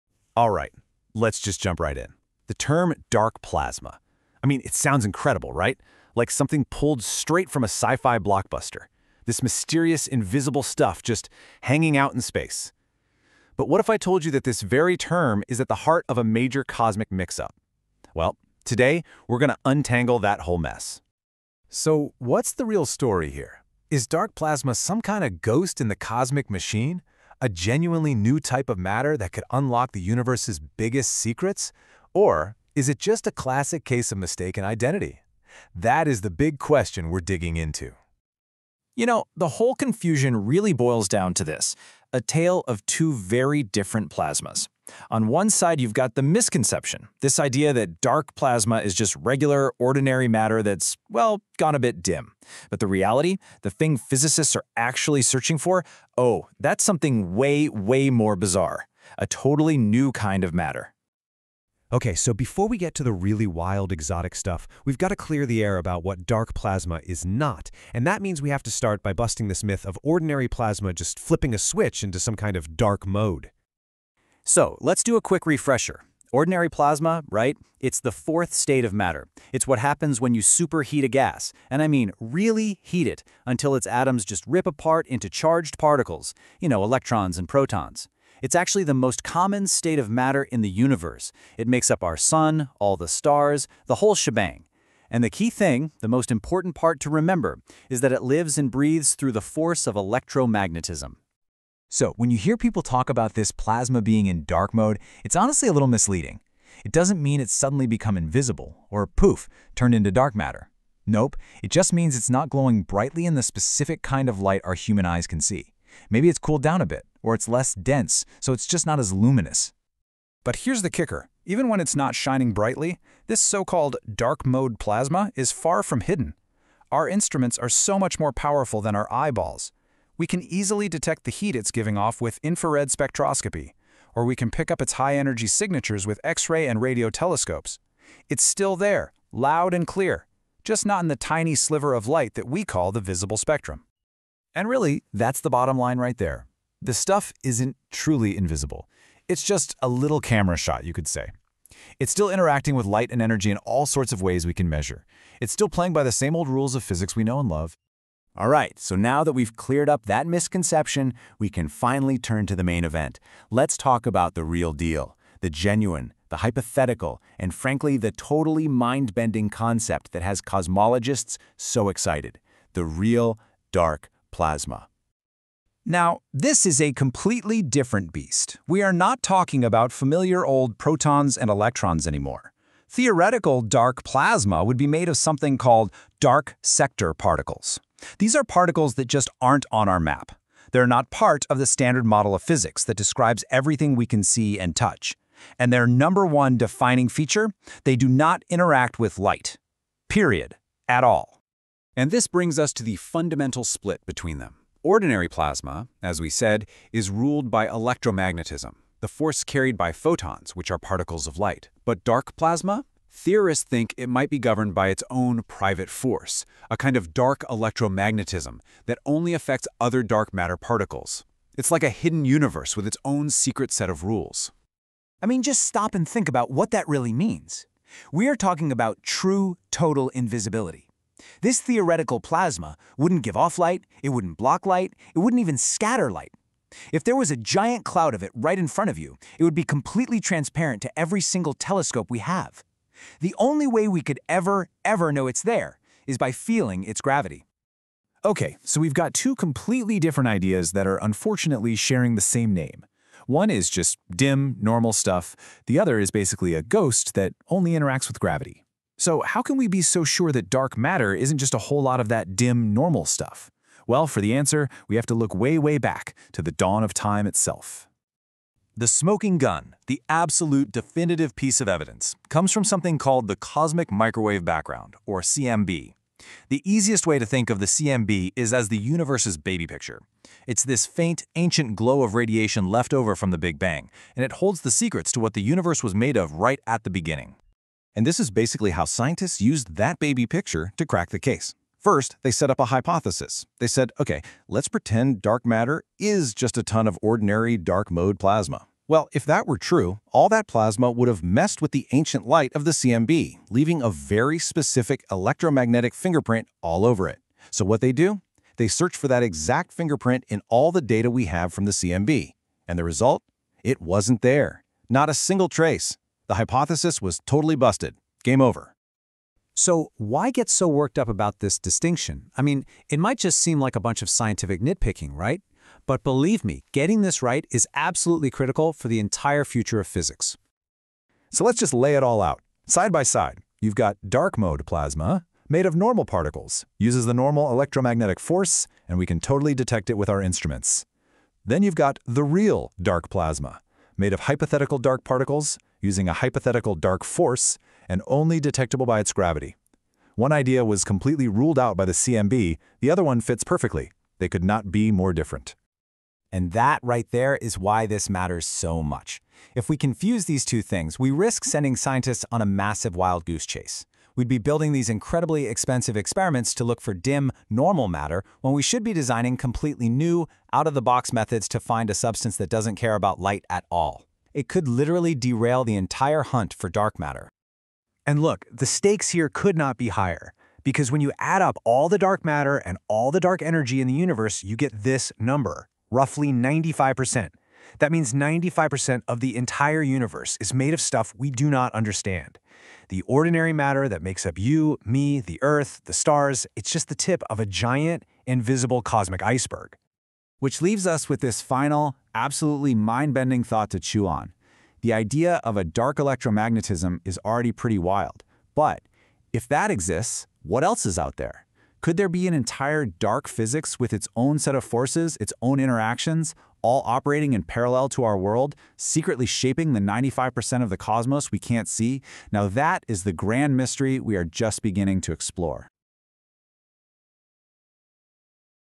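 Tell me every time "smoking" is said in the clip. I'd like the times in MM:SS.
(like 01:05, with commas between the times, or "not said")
04:28.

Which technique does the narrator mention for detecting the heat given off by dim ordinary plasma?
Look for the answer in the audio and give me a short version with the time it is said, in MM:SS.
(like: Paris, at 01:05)
infrared spectroscopy, at 02:12.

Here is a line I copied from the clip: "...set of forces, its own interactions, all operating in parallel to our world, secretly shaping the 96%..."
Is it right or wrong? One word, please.
wrong.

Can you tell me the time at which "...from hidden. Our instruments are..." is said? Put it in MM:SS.
02:05.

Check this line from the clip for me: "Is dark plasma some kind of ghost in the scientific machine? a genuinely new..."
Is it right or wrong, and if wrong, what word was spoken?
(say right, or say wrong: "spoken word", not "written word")
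wrong: "cosmic", not "scientific".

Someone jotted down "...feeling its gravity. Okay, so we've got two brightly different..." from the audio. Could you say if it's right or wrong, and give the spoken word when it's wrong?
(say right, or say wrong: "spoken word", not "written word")
wrong: "completely", not "brightly".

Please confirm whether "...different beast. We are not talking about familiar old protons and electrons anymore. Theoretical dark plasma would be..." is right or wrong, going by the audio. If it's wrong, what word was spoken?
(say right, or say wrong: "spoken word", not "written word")
right.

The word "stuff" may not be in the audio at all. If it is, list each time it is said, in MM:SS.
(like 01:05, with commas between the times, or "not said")
00:10, 01:04, 02:26, 04:14, 04:23, 06:30.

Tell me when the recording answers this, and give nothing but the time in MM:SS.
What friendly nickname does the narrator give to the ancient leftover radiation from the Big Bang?
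04:38.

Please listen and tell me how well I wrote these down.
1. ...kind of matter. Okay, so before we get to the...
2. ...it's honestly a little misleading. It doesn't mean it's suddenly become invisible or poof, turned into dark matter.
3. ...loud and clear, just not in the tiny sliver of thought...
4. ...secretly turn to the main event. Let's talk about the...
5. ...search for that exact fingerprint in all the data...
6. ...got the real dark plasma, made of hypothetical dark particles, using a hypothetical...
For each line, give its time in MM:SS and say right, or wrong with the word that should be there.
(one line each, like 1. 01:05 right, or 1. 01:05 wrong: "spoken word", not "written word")
1. 01:00 right
2. 01:45 right
3. 02:19 wrong: "light", not "thought"
4. 02:41 wrong: "finally", not "secretly"
5. 05:08 right
6. 05:41 right.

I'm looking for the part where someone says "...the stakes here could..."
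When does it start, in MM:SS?
06:18.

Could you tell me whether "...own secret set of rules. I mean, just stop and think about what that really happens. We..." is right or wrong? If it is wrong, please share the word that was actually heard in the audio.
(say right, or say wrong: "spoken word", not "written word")
wrong: "means", not "happens".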